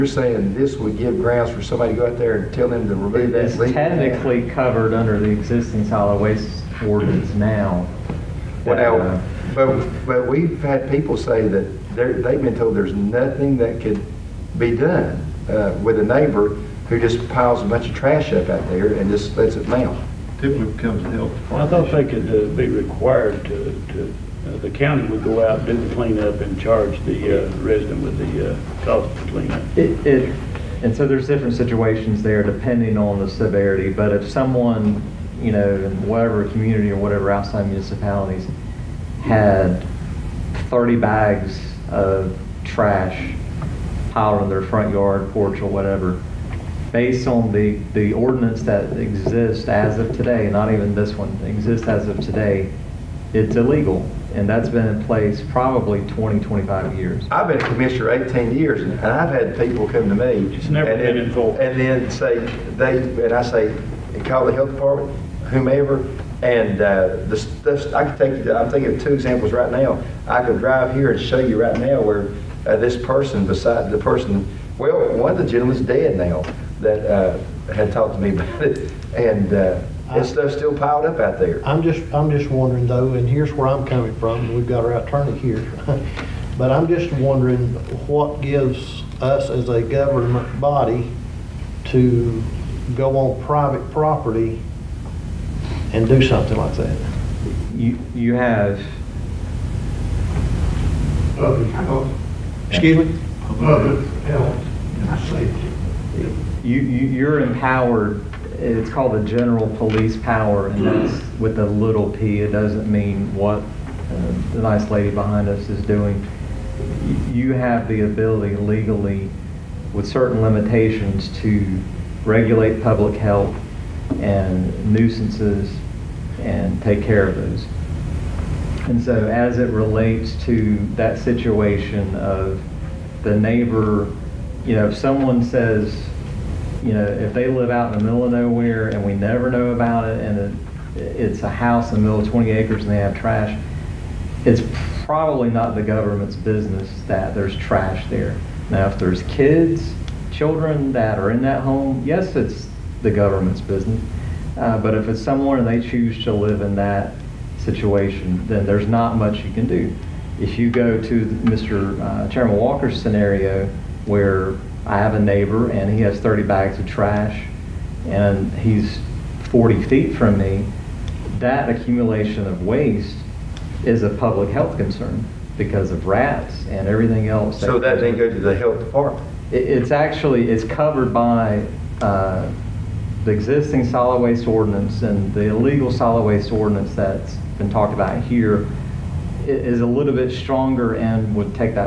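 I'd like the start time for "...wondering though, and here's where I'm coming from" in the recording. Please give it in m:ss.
1:22.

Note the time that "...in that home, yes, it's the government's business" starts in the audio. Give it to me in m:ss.
2:31.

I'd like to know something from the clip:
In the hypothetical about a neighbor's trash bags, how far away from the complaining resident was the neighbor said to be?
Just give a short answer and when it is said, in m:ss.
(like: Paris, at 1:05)
40 feet, at 2:49.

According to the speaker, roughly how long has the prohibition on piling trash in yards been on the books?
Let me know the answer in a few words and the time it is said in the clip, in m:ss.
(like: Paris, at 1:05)
20, 25 years, at 0:56.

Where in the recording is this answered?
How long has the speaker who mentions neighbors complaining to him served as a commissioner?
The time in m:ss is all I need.
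0:58.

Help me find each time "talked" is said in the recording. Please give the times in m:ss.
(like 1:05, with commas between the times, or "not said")
1:17, 3:07.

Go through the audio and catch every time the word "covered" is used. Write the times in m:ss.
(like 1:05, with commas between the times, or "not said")
0:04, 3:00.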